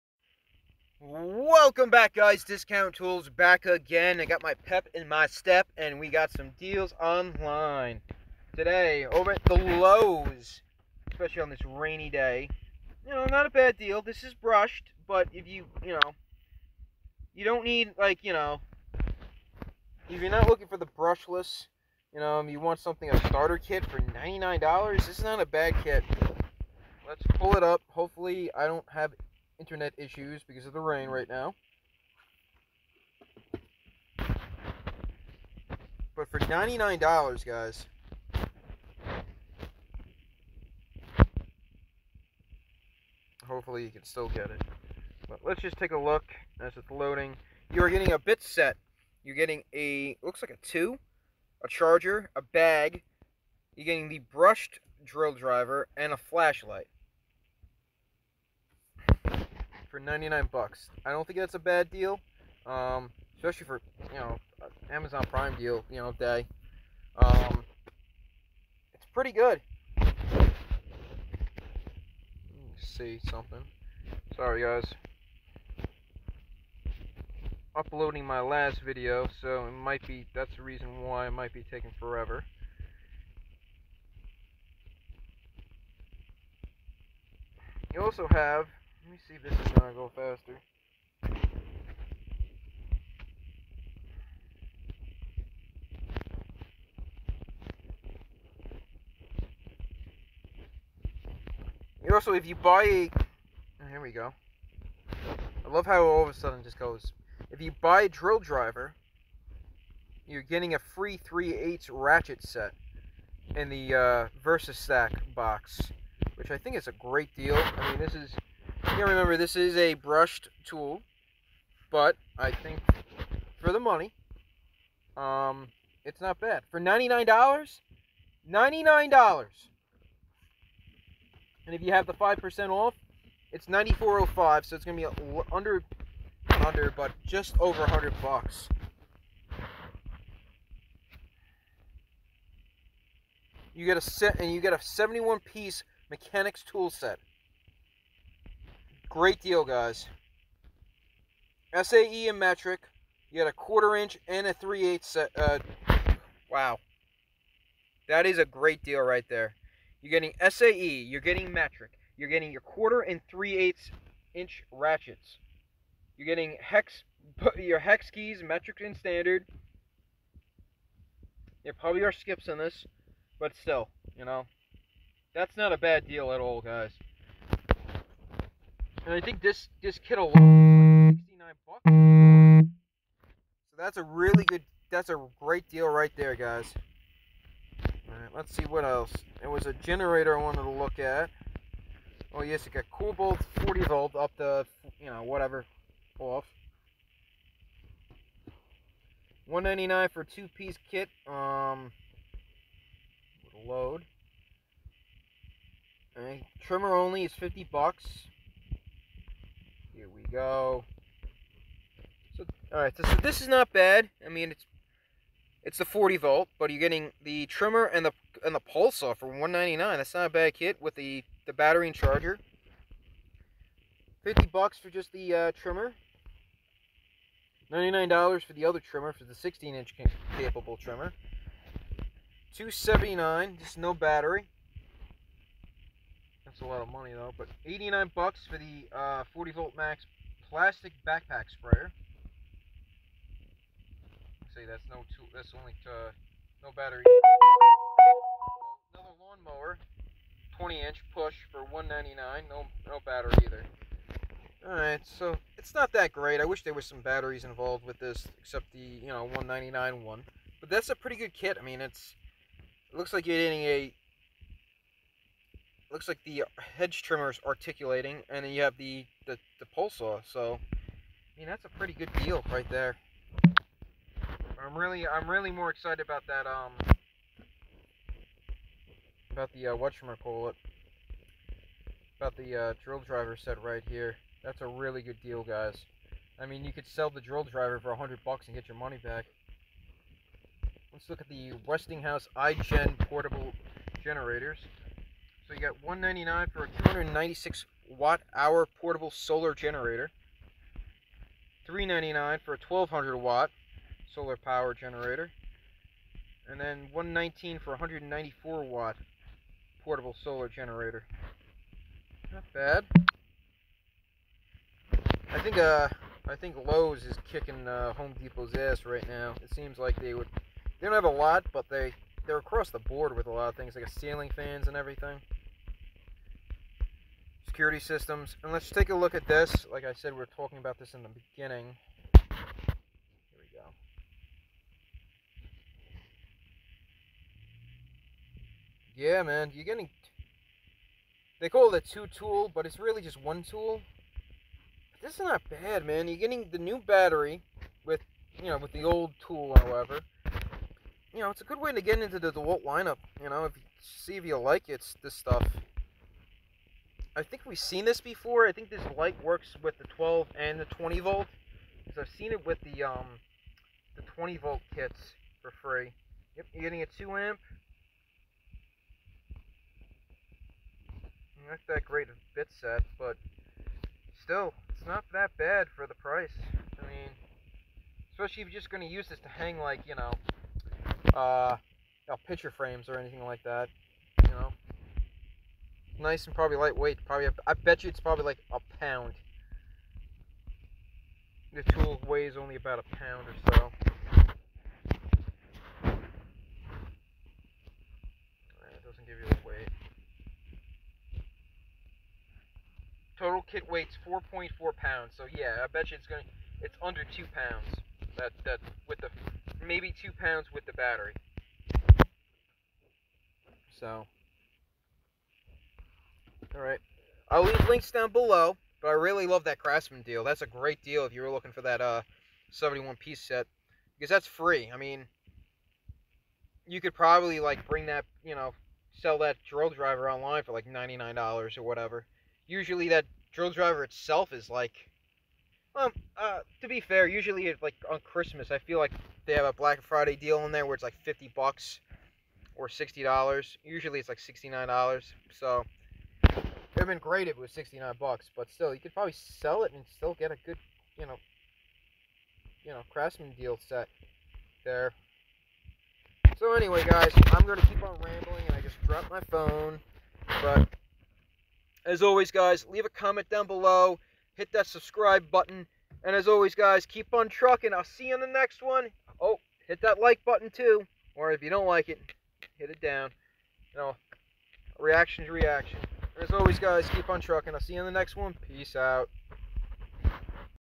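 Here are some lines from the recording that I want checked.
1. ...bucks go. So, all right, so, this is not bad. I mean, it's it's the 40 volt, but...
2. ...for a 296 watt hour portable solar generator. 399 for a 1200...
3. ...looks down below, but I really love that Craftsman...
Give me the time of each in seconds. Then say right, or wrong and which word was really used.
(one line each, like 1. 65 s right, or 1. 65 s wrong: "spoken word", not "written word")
1. 207 s right
2. 296 s right
3. 417 s wrong: "links", not "looks".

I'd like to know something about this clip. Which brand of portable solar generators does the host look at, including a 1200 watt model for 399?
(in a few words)
Westinghouse.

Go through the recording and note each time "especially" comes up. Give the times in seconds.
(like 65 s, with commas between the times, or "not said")
11 s, 63 s, 378 s.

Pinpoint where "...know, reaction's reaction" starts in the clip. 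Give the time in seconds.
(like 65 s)
473 s.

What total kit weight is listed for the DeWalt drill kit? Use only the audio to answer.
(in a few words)
4.4 pounds.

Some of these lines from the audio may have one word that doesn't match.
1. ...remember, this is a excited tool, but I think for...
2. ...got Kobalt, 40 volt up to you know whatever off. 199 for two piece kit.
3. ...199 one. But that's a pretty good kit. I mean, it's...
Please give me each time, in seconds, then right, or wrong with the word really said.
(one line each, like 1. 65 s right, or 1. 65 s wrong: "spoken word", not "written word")
1. 119 s wrong: "brushed", not "excited"
2. 192 s right
3. 259 s right.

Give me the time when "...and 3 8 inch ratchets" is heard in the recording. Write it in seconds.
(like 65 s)
163 s.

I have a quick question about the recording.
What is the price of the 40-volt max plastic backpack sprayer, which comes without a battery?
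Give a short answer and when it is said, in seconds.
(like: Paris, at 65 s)
$89, at 237 s.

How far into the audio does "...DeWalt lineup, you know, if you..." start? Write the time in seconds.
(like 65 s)
352 s.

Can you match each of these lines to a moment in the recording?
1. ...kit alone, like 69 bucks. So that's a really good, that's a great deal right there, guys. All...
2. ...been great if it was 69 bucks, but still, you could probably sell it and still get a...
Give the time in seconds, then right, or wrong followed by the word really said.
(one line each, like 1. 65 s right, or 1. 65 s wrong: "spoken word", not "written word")
1. 179 s right
2. 447 s right.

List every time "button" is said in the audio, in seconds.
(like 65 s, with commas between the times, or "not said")
465 s, 470 s.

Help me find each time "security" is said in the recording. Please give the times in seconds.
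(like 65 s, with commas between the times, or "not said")
327 s.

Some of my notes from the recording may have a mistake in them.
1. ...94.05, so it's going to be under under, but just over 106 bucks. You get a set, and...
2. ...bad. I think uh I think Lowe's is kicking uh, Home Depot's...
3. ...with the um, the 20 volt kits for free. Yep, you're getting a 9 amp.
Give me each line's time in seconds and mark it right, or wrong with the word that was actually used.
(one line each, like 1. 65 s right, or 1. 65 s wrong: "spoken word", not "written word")
1. 133 s wrong: "100", not "106"
2. 312 s right
3. 362 s wrong: "2", not "9".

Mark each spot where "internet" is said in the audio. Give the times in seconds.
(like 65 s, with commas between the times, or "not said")
29 s.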